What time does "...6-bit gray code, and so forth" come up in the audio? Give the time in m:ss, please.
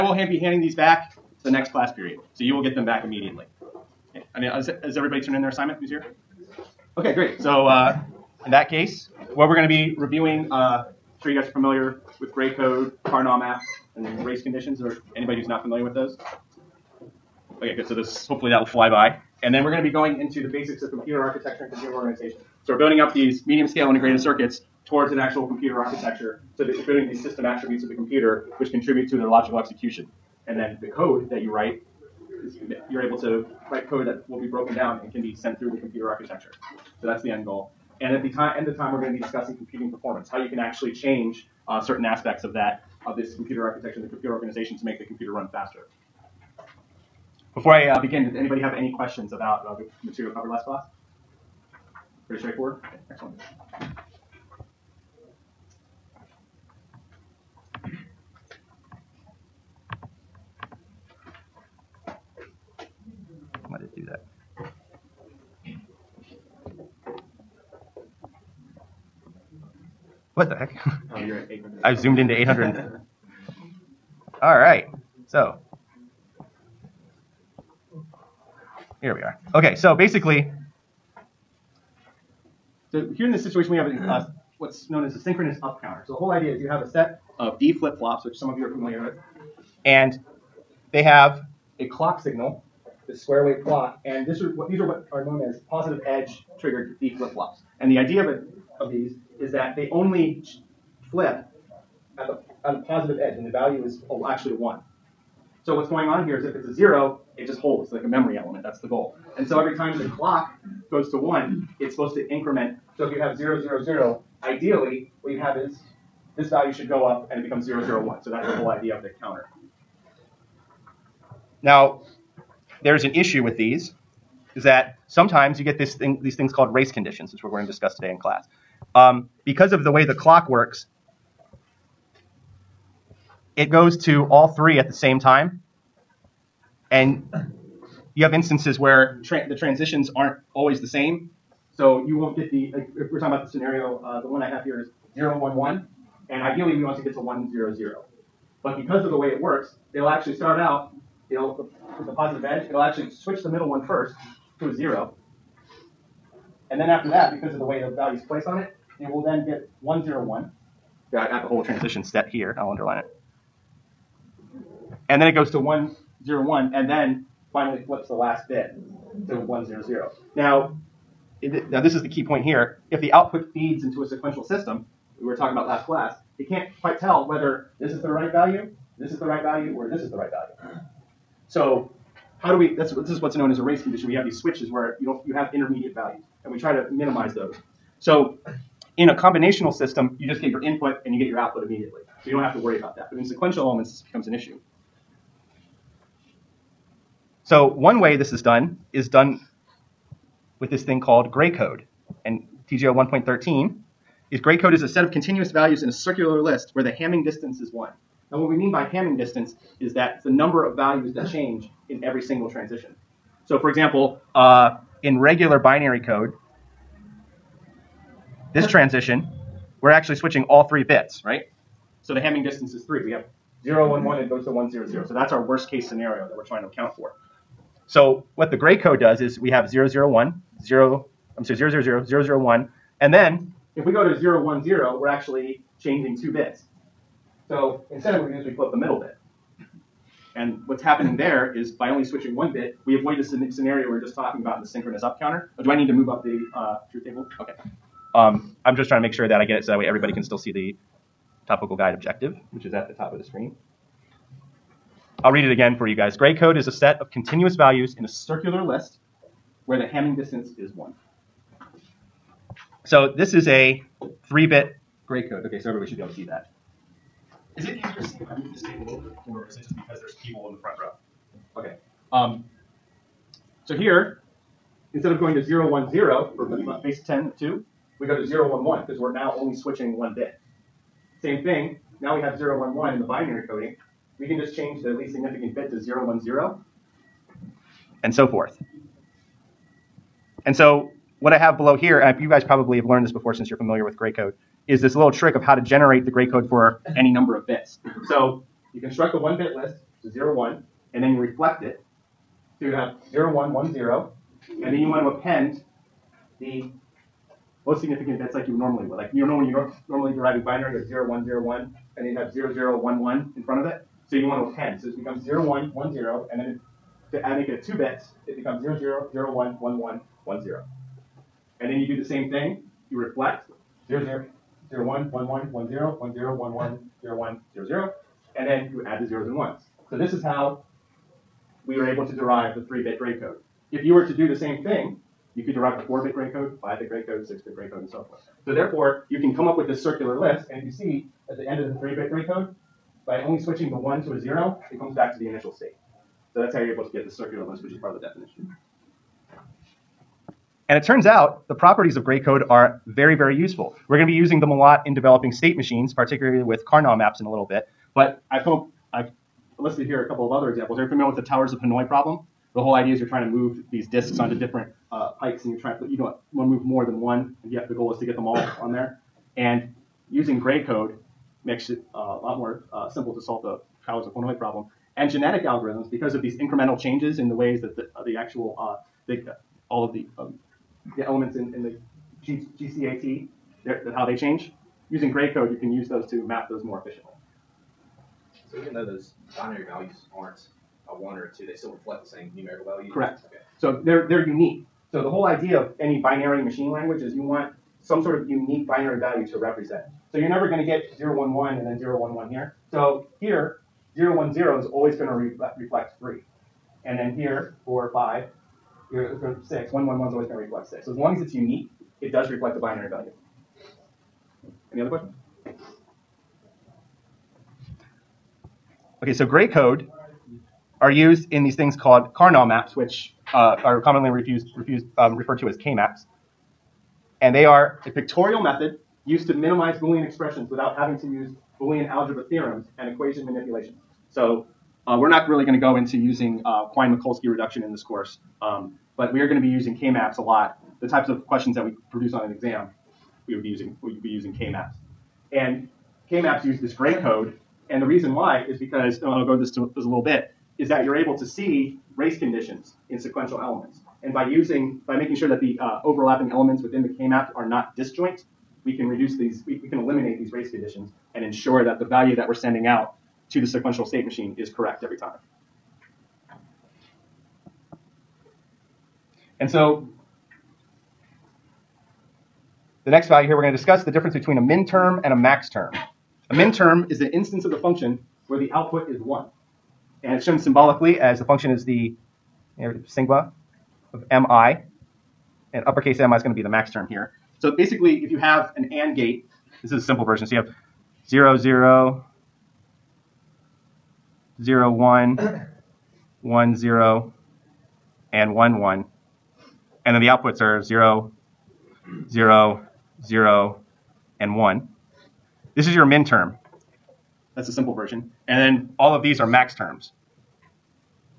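5:37.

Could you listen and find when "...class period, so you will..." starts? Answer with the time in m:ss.
0:01.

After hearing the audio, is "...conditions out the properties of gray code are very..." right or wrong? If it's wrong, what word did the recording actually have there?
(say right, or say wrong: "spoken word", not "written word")
wrong: "turns", not "conditions".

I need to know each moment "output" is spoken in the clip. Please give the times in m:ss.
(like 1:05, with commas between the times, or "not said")
2:53, 3:11, 7:58, 8:20.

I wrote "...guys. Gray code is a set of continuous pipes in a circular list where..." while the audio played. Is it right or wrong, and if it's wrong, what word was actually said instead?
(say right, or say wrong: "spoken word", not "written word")
wrong: "values", not "pipes".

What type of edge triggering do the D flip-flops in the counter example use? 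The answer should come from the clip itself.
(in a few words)
positive edge triggered.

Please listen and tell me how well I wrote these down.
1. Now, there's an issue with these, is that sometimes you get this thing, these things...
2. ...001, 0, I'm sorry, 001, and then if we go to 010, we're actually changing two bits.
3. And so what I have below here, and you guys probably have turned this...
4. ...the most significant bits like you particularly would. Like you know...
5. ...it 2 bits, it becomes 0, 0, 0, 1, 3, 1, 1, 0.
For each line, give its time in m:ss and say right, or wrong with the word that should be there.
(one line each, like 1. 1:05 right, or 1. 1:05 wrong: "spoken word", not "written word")
1. 2:01 right
2. 3:49 right
3. 4:50 wrong: "learned", not "turned"
4. 5:06 wrong: "normally", not "particularly"
5. 5:17 wrong: "1", not "3".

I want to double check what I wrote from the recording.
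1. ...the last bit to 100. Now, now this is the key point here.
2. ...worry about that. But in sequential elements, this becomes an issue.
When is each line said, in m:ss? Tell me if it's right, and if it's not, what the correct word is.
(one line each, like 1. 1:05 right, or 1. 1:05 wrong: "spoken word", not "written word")
1. 2:48 right
2. 3:12 right.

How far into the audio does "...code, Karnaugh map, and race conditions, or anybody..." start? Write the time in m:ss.
0:12.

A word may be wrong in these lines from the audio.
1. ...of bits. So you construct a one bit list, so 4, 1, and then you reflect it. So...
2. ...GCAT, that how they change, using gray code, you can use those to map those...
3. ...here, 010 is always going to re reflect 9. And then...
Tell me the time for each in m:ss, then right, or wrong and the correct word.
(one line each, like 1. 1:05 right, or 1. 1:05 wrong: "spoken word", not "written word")
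1. 4:57 wrong: "0", not "4"
2. 6:22 right
3. 6:43 wrong: "3", not "9".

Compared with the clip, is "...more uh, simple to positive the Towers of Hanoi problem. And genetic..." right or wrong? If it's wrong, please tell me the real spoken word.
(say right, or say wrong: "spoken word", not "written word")
wrong: "solve", not "positive".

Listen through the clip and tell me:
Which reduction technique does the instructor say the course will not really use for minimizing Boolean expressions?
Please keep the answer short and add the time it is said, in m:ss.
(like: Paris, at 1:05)
Quine-McCluskey reduction, at 7:16.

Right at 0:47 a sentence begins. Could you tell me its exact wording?
Before I uh, begin, does anybody have any questions about uh, the material covered last class?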